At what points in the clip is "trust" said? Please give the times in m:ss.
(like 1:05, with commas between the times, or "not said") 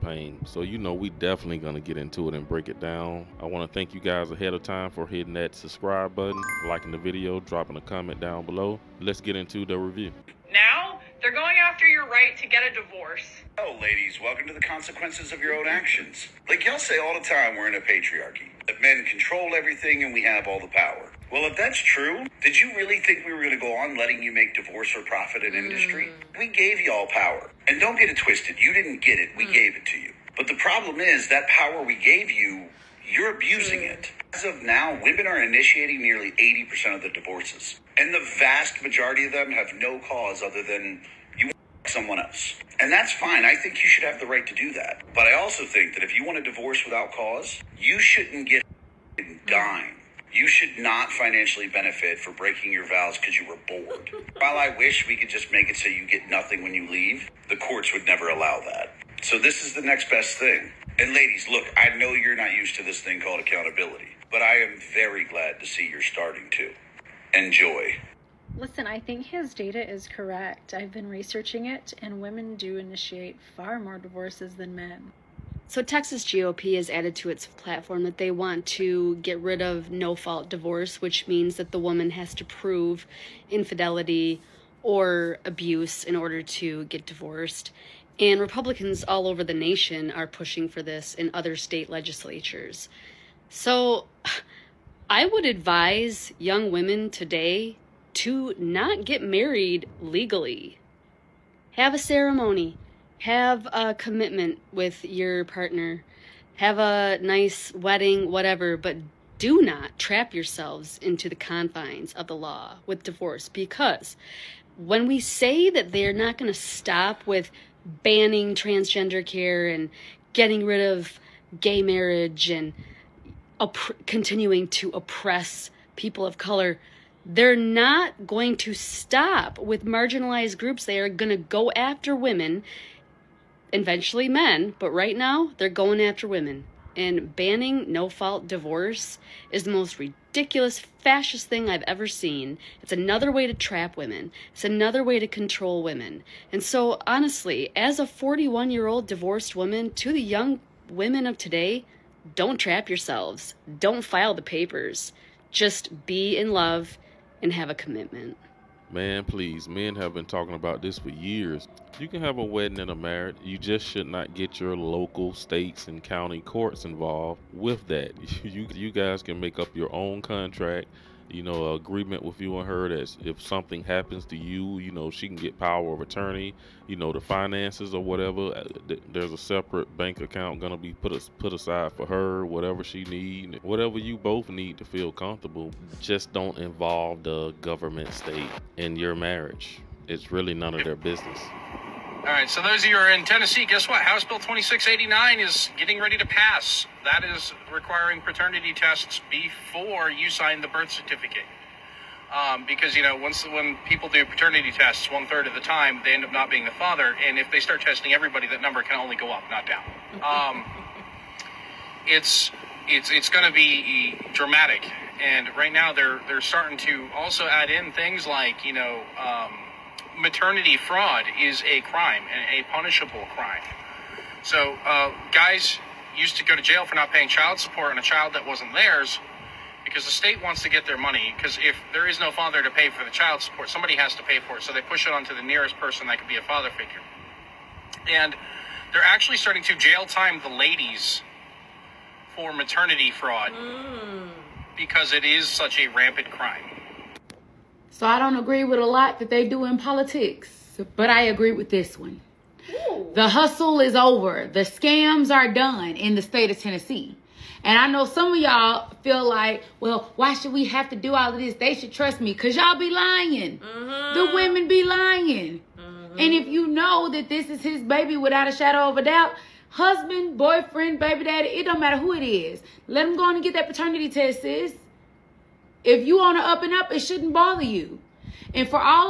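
4:21.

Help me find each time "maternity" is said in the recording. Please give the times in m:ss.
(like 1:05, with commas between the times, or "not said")
3:40, 4:02.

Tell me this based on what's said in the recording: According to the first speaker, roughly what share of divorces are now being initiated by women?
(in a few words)
80%.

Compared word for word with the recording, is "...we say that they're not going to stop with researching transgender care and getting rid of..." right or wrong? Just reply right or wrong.
wrong.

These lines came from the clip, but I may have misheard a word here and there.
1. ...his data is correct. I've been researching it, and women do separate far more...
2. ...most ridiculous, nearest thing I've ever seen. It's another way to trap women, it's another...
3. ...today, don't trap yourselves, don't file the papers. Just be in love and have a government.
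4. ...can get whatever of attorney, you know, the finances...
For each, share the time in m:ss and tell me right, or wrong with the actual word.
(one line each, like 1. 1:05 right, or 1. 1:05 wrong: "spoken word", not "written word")
1. 1:09 wrong: "initiate", not "separate"
2. 2:19 wrong: "fascist", not "nearest"
3. 2:31 wrong: "commitment", not "government"
4. 2:55 wrong: "power", not "whatever".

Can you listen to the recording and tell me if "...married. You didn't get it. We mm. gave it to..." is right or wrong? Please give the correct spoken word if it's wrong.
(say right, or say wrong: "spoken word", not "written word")
wrong: "twisted", not "married".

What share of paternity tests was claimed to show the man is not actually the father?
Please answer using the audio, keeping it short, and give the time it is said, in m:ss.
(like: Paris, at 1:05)
one third, at 3:25.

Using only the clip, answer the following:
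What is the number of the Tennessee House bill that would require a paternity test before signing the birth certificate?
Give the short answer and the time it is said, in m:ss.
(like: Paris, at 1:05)
2689, at 3:14.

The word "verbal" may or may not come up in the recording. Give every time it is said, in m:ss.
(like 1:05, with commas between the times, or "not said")
not said.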